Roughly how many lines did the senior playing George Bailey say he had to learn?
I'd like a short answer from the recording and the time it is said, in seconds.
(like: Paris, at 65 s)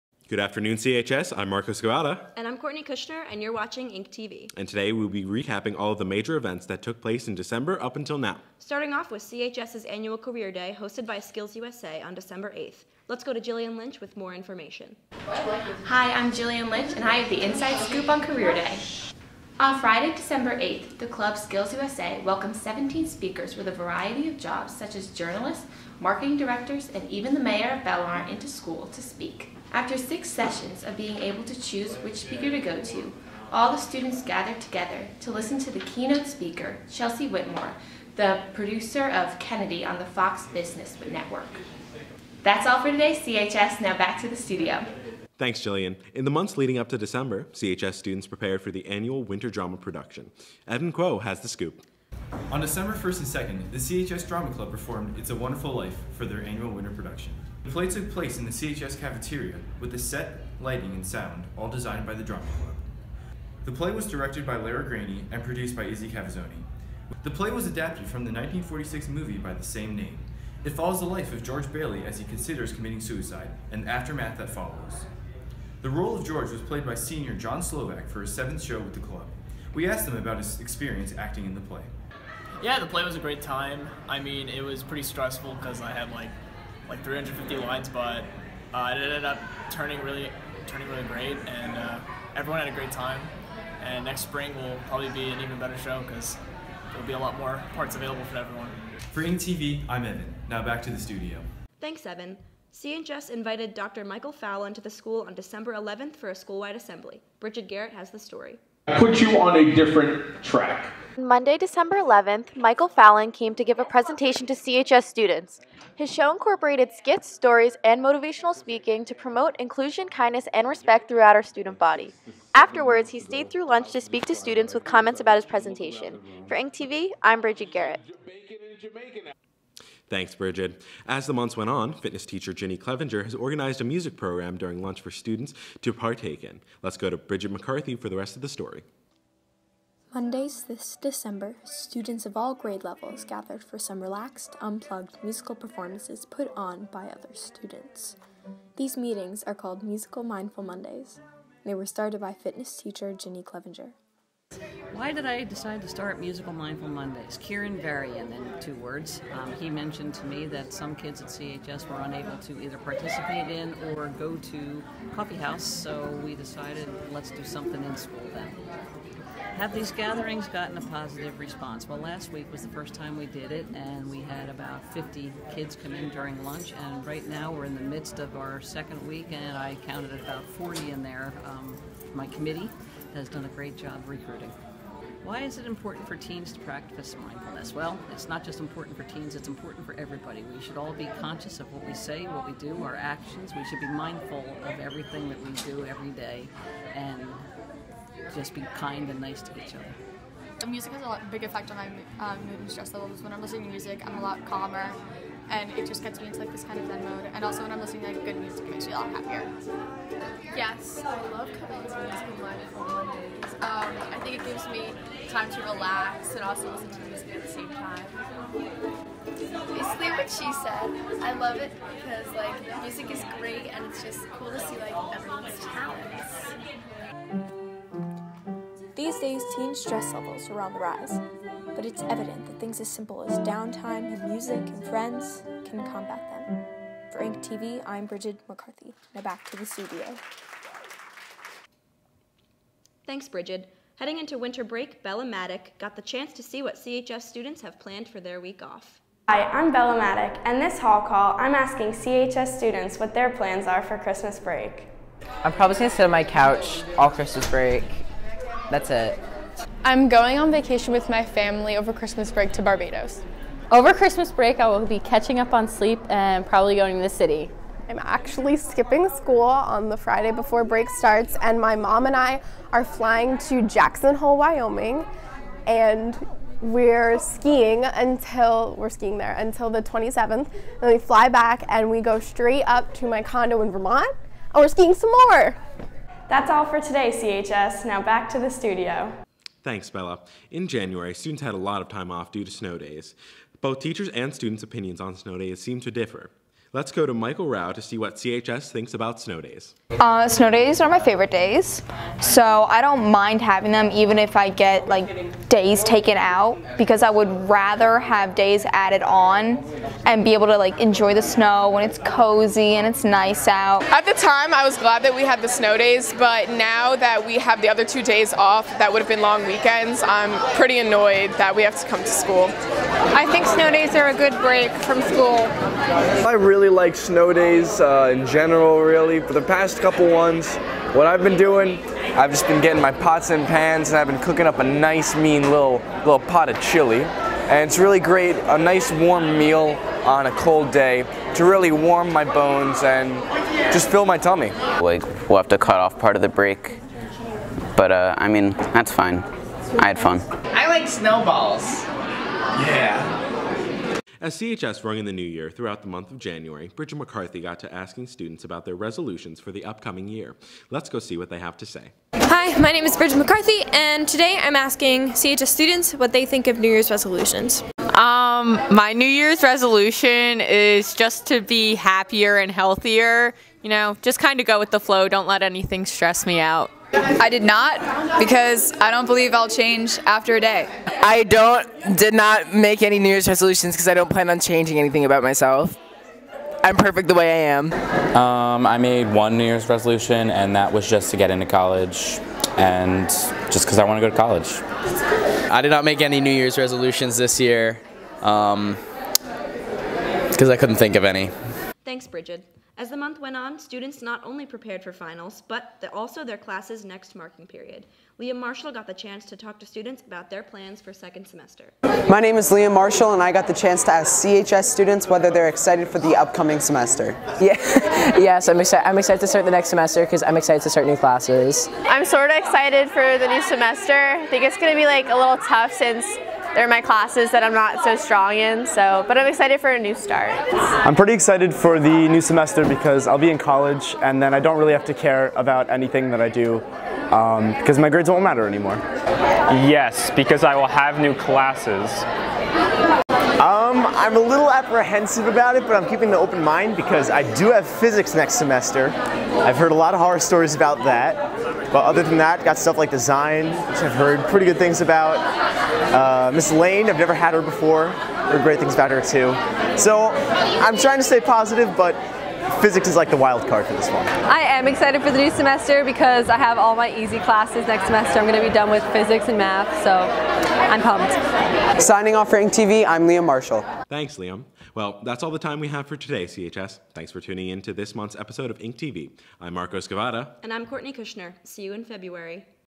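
350, at 87 s.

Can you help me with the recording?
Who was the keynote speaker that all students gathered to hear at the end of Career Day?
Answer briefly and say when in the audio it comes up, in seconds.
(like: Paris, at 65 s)
Chelsea Whitmore, at 36 s.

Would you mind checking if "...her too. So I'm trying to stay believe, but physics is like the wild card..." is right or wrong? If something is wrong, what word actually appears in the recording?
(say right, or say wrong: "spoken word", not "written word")
wrong: "positive", not "believe".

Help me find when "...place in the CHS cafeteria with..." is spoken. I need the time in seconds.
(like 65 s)
58 s.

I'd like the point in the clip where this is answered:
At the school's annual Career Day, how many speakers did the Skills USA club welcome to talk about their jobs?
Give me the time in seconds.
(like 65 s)
22 s.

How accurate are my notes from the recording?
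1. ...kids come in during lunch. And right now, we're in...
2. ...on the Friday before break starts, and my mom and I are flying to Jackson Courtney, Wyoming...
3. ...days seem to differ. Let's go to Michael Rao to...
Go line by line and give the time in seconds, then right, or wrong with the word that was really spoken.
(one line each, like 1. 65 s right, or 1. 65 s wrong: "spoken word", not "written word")
1. 175 s right
2. 269 s wrong: "Hole", not "Courtney"
3. 295 s right.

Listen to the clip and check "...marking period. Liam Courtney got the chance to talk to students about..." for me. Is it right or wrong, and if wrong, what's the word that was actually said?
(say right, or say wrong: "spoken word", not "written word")
wrong: "Marshall", not "Courtney".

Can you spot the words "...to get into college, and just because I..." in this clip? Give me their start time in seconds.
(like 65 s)
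391 s.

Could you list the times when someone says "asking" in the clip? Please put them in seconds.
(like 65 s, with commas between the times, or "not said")
251 s, 357 s, 364 s.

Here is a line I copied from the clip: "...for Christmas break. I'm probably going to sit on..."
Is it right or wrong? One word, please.
right.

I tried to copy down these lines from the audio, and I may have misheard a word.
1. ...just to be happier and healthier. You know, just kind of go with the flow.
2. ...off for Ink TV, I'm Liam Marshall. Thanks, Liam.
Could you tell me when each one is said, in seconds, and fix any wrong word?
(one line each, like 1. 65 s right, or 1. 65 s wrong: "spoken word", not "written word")
1. 370 s right
2. 472 s right.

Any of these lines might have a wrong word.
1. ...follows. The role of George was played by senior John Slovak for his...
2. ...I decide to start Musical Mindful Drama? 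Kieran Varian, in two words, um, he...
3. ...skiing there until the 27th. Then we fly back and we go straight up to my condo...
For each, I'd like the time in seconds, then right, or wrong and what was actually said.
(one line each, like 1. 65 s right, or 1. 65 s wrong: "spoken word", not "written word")
1. 74 s right
2. 155 s wrong: "Mondays", not "Drama"
3. 278 s right.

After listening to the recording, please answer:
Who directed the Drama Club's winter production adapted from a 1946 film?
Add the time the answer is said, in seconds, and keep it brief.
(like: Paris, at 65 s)
Lara Graney, at 64 s.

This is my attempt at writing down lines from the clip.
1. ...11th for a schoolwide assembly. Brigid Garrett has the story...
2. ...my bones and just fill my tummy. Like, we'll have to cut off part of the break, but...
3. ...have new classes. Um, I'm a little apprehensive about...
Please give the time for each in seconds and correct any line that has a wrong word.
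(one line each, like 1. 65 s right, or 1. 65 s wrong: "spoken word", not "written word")
1. 105 s right
2. 342 s right
3. 440 s right.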